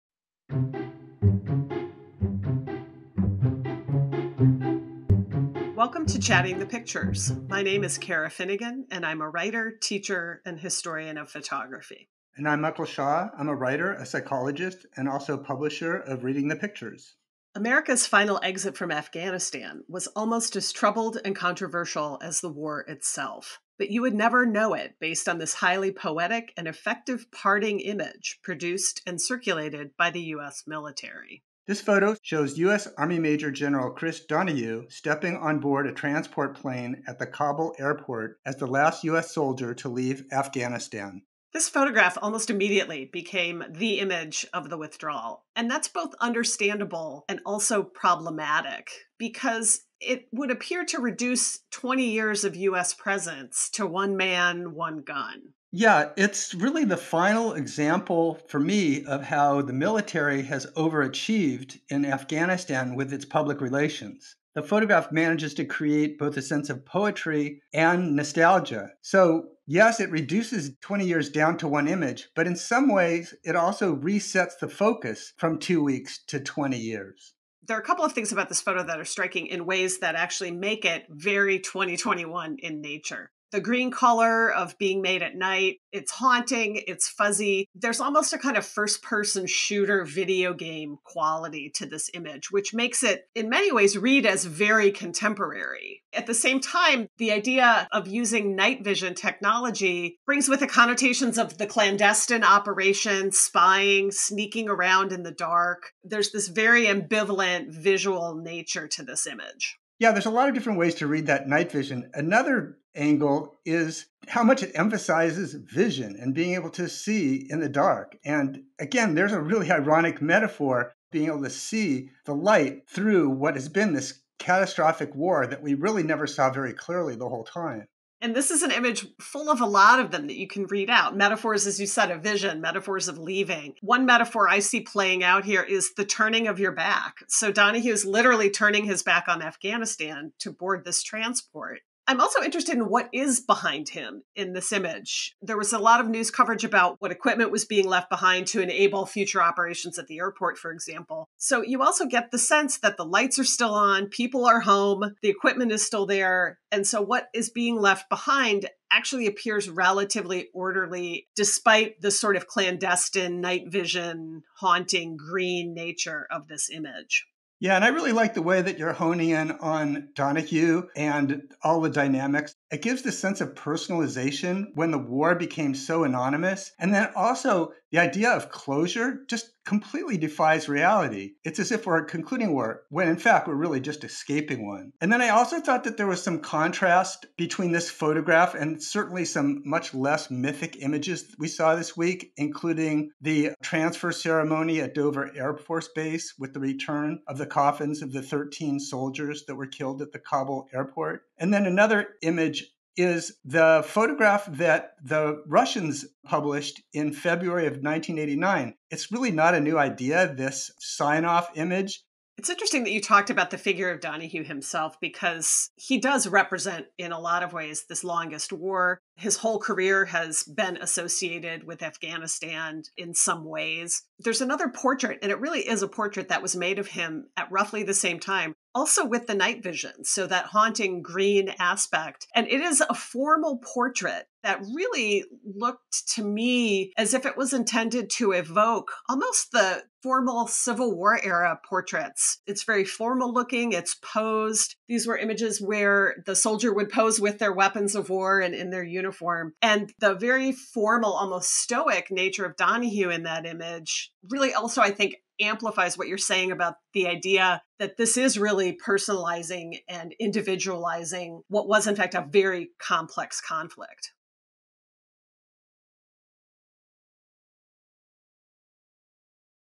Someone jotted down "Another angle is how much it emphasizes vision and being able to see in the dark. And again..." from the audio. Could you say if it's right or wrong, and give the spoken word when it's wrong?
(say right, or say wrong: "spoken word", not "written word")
right.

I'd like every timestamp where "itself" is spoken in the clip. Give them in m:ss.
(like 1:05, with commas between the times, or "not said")
0:22.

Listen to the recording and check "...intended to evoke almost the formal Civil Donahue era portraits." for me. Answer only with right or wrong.
wrong.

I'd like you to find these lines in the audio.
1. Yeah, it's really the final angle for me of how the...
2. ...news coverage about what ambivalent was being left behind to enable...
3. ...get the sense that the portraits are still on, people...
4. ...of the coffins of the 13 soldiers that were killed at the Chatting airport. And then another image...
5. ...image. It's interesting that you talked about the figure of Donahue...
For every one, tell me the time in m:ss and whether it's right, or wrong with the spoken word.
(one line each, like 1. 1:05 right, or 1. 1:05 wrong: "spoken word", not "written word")
1. 0:55 wrong: "example", not "angle"
2. 2:26 wrong: "equipment", not "ambivalent"
3. 2:32 wrong: "lights", not "portraits"
4. 3:17 wrong: "Kabul", not "Chatting"
5. 3:31 right.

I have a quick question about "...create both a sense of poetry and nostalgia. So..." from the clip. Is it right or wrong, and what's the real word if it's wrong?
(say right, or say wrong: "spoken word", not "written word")
right.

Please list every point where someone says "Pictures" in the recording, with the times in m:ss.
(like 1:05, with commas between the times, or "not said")
0:06, 0:16.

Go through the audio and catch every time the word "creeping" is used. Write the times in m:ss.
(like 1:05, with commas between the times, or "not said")
not said.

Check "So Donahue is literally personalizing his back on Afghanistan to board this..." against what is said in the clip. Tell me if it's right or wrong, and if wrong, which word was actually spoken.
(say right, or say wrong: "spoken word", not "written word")
wrong: "turning", not "personalizing".